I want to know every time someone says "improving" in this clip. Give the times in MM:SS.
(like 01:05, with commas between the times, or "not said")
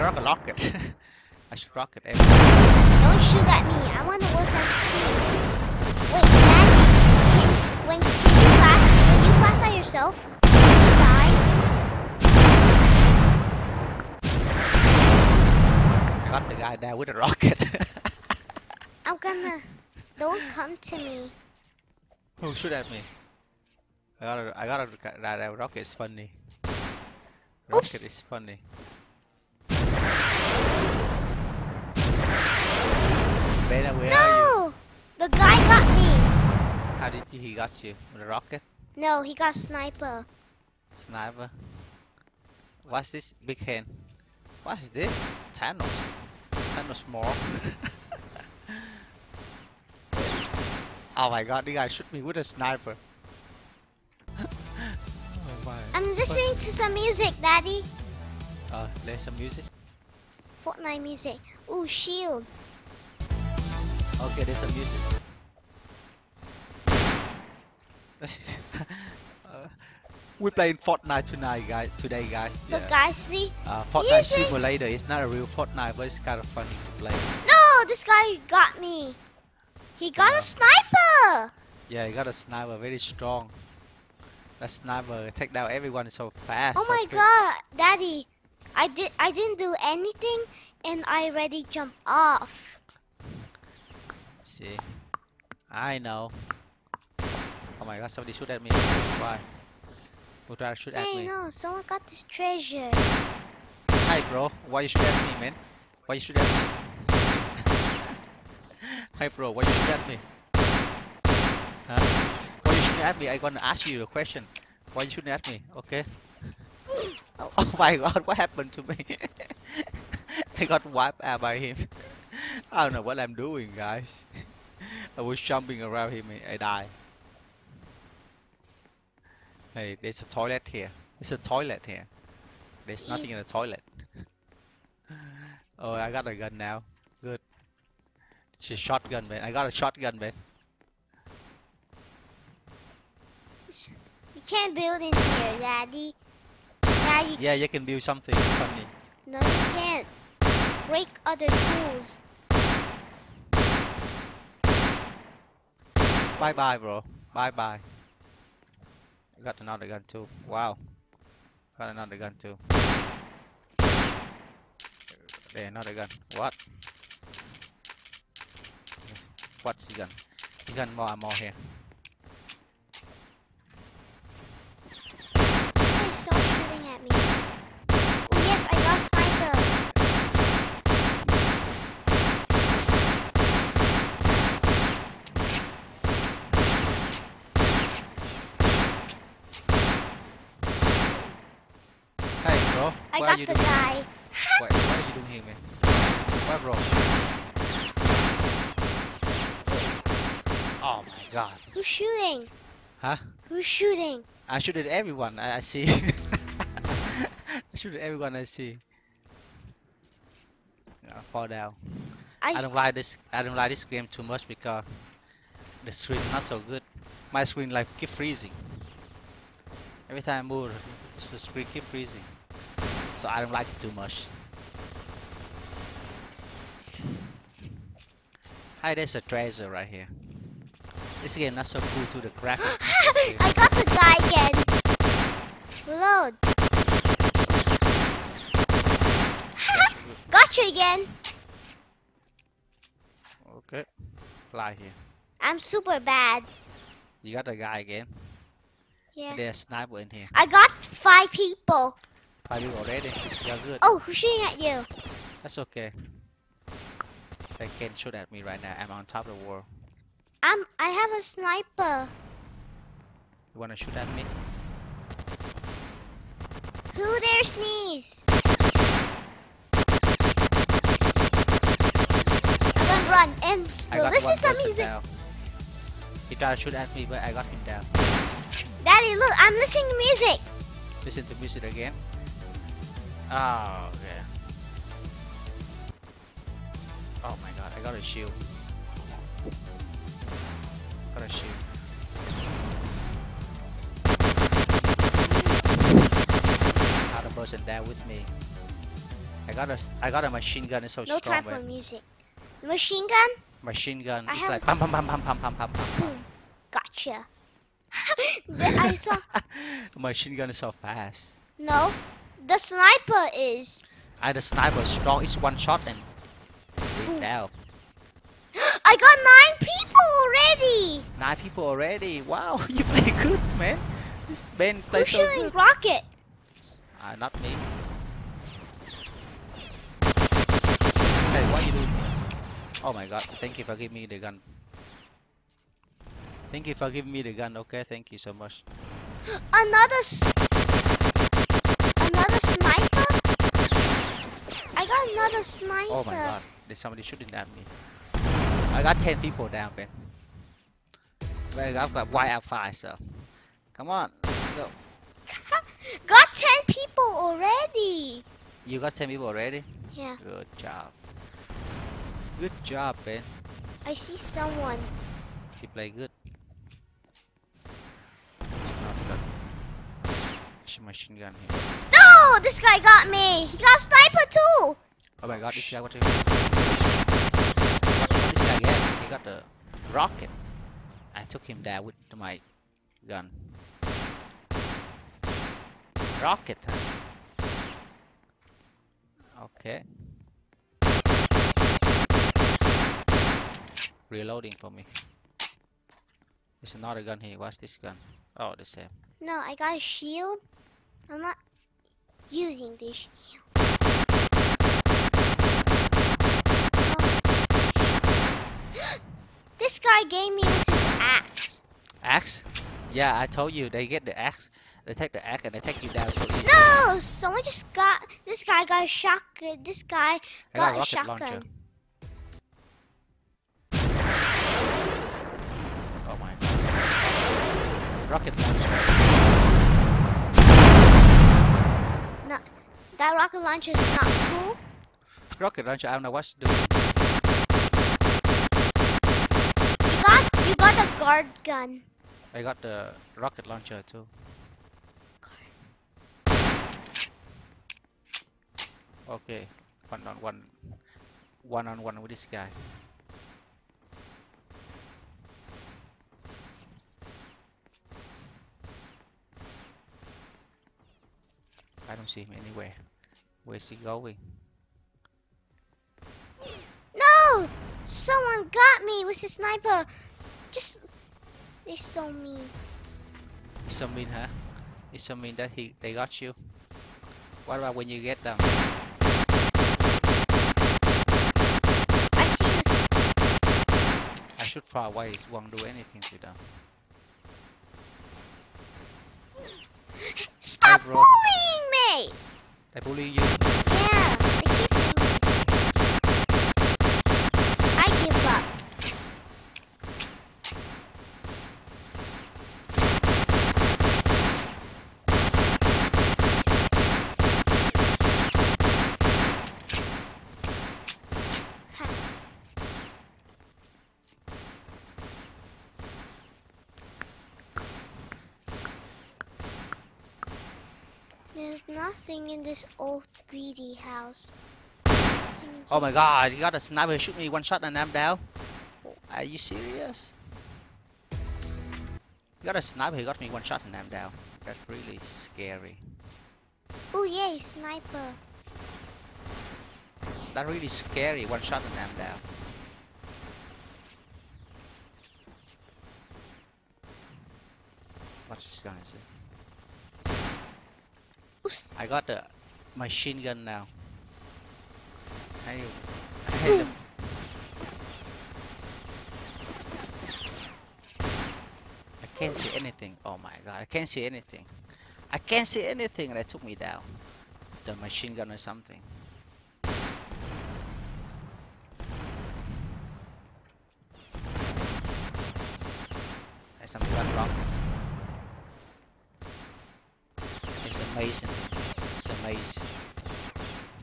not said.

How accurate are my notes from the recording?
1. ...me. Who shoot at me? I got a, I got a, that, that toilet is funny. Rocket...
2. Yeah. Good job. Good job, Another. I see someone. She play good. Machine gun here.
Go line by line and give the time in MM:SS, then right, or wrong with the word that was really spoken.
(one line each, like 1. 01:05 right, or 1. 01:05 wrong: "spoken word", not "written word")
1. 00:20 wrong: "rocket", not "toilet"
2. 05:59 wrong: "Ben", not "Another".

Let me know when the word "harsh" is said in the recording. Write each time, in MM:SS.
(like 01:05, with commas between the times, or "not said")
not said.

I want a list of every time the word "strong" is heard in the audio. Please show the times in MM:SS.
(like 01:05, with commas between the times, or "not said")
01:22, 05:01, 05:14.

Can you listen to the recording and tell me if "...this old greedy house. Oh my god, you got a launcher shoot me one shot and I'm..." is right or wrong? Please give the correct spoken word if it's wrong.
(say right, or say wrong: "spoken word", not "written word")
wrong: "sniper", not "launcher".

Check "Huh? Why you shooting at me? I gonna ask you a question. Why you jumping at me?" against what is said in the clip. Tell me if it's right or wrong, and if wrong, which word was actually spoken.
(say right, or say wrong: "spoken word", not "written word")
wrong: "shooting", not "jumping".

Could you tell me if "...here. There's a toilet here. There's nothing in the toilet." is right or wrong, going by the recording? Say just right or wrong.
right.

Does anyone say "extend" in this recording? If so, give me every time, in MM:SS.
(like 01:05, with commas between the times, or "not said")
not said.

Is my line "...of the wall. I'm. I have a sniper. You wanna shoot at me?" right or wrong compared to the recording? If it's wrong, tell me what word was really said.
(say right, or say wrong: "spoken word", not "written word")
right.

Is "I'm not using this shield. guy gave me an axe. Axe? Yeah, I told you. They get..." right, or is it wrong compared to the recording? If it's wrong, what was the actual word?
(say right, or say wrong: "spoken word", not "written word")
right.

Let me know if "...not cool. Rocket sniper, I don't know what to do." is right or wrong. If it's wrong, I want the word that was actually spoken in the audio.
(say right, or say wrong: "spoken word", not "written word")
wrong: "launcher", not "sniper".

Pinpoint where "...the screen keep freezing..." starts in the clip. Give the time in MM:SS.
03:41.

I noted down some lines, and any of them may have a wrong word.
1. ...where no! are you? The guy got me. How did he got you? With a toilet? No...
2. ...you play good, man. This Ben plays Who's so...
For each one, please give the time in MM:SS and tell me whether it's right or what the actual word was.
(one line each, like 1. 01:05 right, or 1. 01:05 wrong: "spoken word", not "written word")
1. 00:33 wrong: "rocket", not "toilet"
2. 05:22 right.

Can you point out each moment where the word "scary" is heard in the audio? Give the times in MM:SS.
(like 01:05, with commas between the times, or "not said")
08:55, 09:00.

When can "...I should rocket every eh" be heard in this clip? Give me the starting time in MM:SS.
00:01.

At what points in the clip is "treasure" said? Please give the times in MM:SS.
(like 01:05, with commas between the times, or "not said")
01:42, 03:49.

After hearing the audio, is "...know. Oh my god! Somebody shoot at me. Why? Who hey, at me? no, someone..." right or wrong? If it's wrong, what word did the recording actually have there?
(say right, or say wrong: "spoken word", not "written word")
right.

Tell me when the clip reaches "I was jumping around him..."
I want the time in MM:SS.
02:05.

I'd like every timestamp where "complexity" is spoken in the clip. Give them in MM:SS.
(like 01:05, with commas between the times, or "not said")
not said.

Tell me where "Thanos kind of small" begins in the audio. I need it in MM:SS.
00:45.